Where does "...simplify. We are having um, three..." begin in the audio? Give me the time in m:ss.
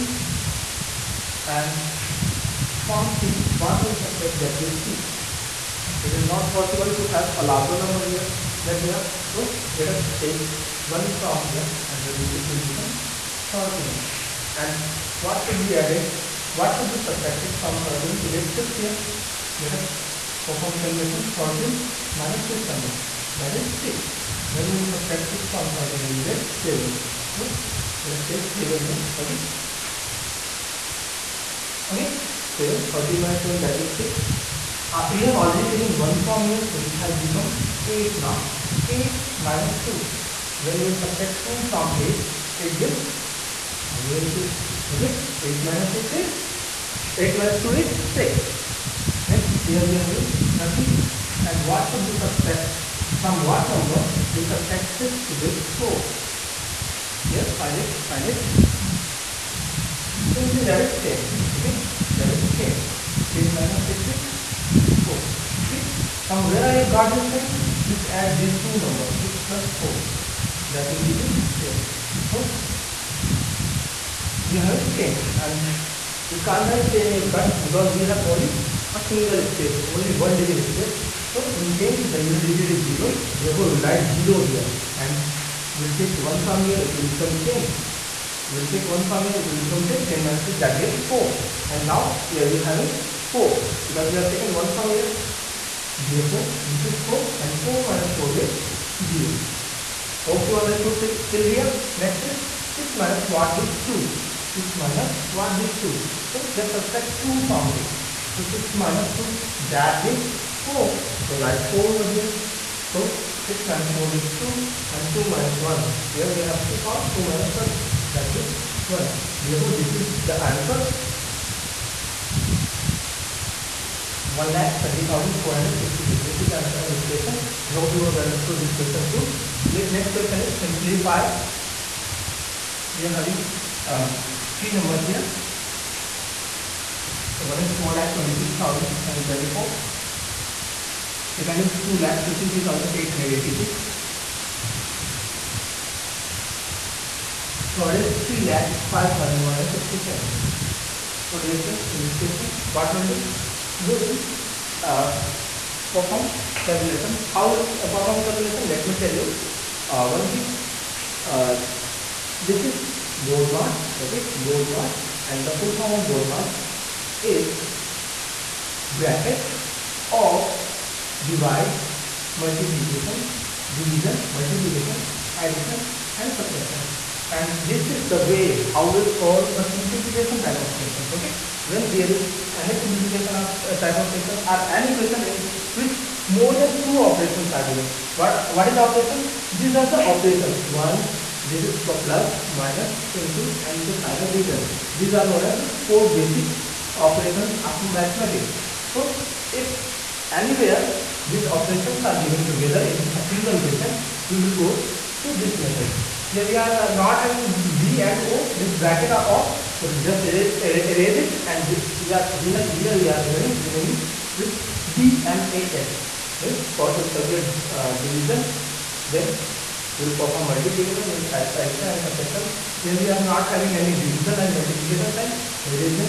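2:10.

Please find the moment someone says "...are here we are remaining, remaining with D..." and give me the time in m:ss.
3:32.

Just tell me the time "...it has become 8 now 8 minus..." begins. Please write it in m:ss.
0:36.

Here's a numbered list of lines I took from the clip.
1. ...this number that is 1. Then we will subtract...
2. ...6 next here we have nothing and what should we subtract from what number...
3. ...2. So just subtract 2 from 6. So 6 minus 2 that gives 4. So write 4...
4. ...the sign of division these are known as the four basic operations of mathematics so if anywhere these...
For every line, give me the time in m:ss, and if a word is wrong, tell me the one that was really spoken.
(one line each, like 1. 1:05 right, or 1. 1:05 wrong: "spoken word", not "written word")
1. 0:22 wrong: "6", not "1"
2. 0:48 right
3. 1:45 right
4. 3:13 right.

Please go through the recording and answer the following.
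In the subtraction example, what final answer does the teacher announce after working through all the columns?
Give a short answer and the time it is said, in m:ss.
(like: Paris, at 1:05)
1,20,466, at 2:04.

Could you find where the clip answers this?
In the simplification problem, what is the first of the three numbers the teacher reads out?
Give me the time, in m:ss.
2:18.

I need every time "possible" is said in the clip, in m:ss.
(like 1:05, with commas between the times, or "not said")
0:06.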